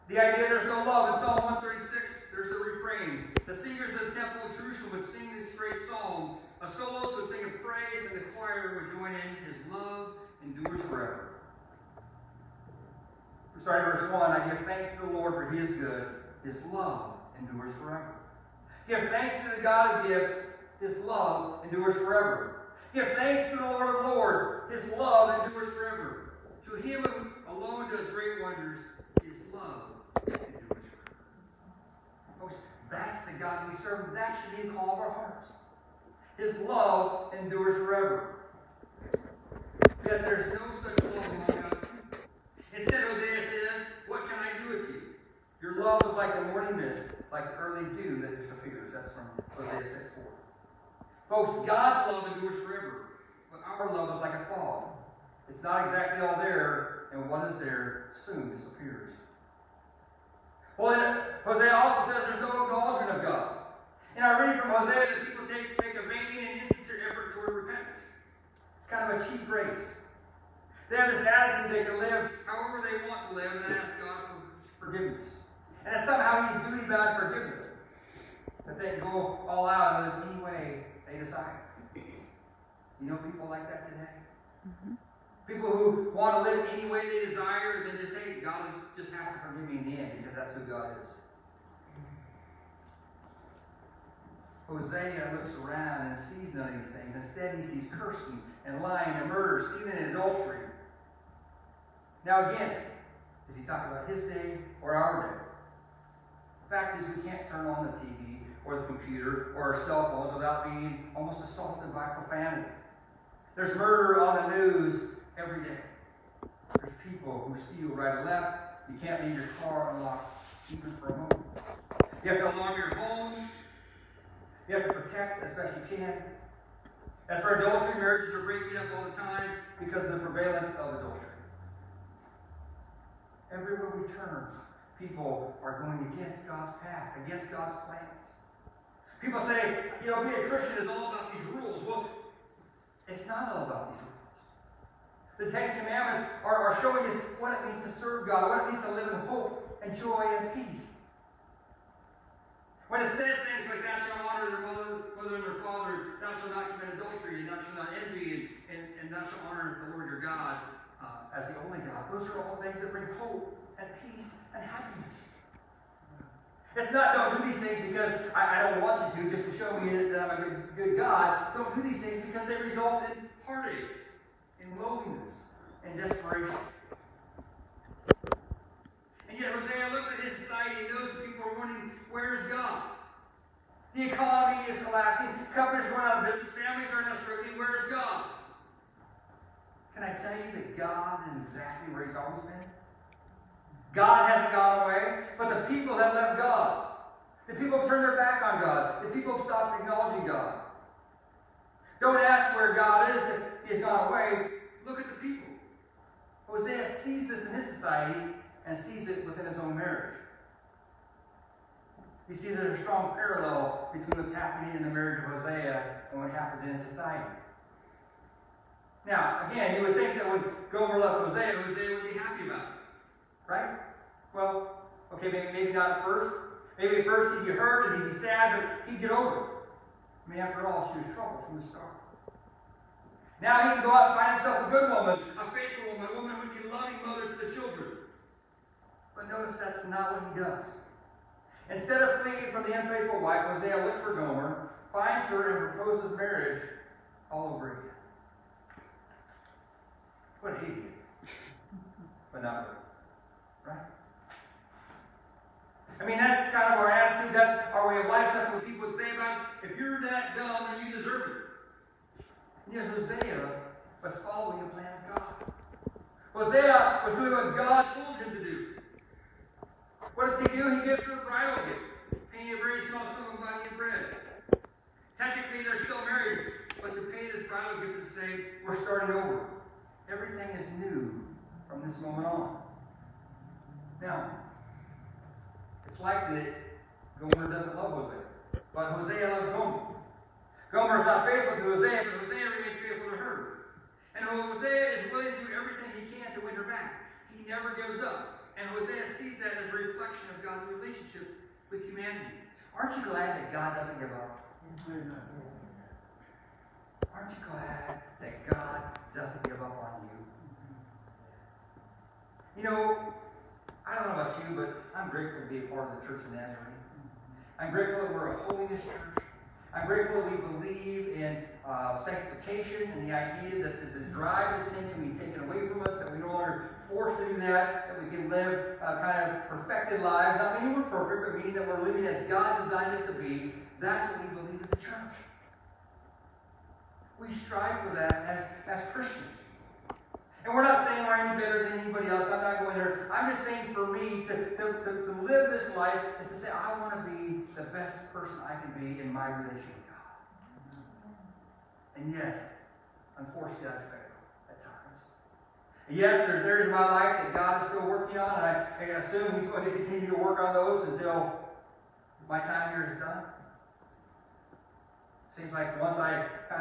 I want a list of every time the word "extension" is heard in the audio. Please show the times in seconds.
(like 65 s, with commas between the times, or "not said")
not said.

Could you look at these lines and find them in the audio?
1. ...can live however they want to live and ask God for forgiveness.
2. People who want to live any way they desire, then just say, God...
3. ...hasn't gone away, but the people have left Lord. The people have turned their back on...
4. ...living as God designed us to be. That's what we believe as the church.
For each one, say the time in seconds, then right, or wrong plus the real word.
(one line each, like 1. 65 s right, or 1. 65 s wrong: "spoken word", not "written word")
1. 71 s right
2. 85 s right
3. 194 s wrong: "God", not "Lord"
4. 331 s right.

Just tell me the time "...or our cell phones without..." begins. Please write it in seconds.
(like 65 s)
109 s.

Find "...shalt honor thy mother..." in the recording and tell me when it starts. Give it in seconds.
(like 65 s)
153 s.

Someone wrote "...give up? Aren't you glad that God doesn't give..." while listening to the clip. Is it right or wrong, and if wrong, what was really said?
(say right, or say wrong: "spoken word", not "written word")
right.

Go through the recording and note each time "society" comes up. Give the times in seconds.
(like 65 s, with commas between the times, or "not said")
180 s, 207 s, 216 s.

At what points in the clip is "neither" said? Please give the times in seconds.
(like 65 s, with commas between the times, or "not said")
not said.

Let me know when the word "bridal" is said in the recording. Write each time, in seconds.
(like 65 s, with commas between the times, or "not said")
271 s, 277 s.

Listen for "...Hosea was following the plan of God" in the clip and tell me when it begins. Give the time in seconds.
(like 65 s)
262 s.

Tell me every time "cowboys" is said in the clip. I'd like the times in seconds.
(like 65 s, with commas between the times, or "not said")
not said.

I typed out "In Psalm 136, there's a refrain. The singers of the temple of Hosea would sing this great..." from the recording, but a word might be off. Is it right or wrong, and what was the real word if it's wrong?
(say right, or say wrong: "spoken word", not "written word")
wrong: "Jerusalem", not "Hosea".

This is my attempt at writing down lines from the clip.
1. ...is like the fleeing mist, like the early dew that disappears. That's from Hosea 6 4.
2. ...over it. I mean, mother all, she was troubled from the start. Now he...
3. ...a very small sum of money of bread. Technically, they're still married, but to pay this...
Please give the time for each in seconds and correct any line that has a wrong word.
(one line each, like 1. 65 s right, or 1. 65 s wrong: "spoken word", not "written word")
1. 46 s wrong: "morning", not "fleeing"
2. 229 s wrong: "after", not "mother"
3. 272 s right.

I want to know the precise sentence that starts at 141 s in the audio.
Well, it's not all about these rules.